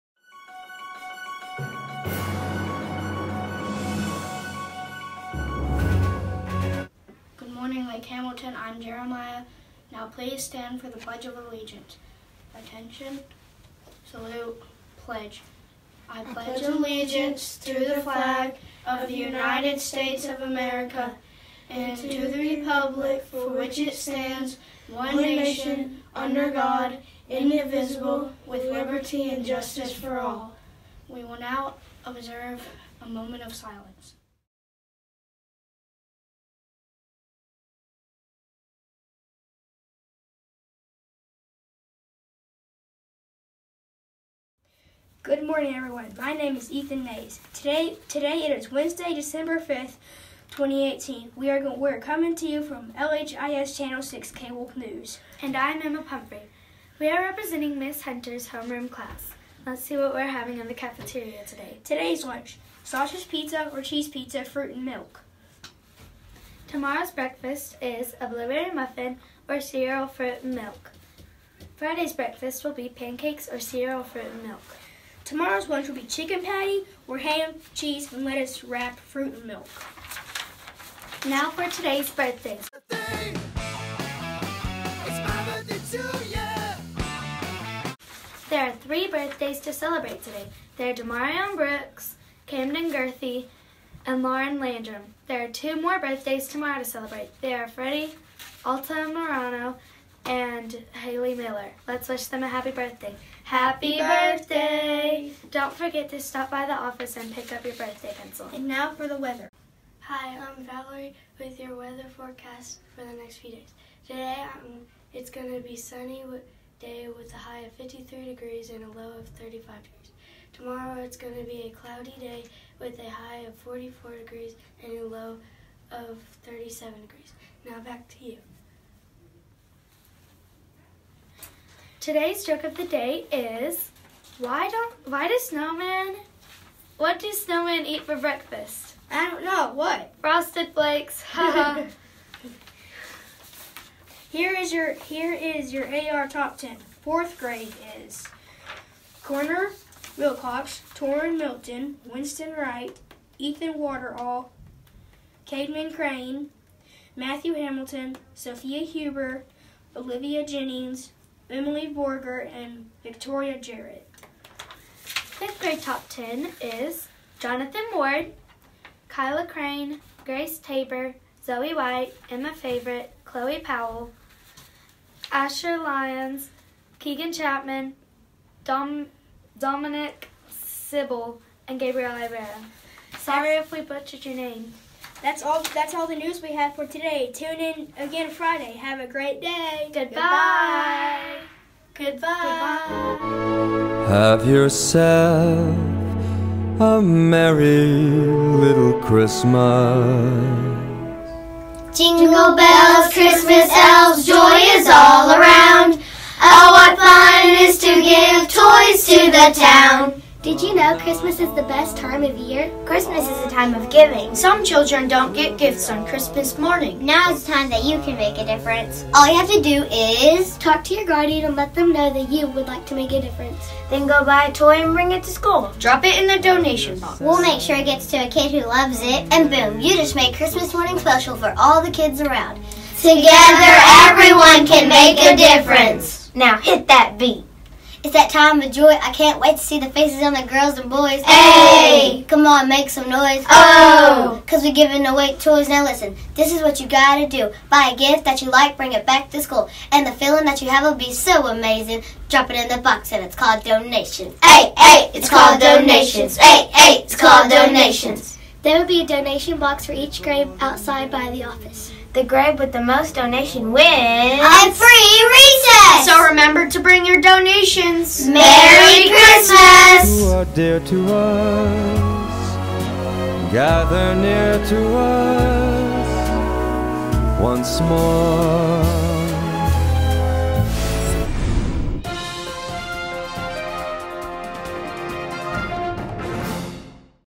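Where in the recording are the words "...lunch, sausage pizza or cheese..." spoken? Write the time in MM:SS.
01:02.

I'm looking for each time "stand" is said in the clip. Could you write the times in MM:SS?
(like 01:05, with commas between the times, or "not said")
00:10, 00:23.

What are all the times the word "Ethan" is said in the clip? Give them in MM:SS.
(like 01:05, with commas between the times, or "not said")
00:46, 02:33.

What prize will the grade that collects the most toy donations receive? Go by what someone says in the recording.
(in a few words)
A free recess.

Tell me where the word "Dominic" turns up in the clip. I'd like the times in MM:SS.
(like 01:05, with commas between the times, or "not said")
02:59.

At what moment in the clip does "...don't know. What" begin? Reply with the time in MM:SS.
02:19.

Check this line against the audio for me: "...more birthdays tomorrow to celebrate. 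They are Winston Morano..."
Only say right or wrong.
wrong.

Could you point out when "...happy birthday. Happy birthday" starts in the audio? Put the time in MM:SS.
01:42.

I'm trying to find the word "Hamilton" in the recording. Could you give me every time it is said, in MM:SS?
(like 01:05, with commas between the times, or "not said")
00:08, 02:37.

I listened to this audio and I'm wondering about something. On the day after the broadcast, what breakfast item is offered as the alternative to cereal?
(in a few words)
Blueberry muffin.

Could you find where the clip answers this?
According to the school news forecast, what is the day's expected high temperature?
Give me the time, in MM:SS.
01:57.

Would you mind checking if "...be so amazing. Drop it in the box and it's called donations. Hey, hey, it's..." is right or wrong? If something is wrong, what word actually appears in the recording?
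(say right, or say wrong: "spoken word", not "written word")
right.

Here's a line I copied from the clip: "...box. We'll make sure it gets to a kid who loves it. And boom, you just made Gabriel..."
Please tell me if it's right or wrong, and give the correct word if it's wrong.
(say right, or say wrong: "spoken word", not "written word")
wrong: "Christmas", not "Gabriel".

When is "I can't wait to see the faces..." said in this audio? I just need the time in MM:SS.
03:58.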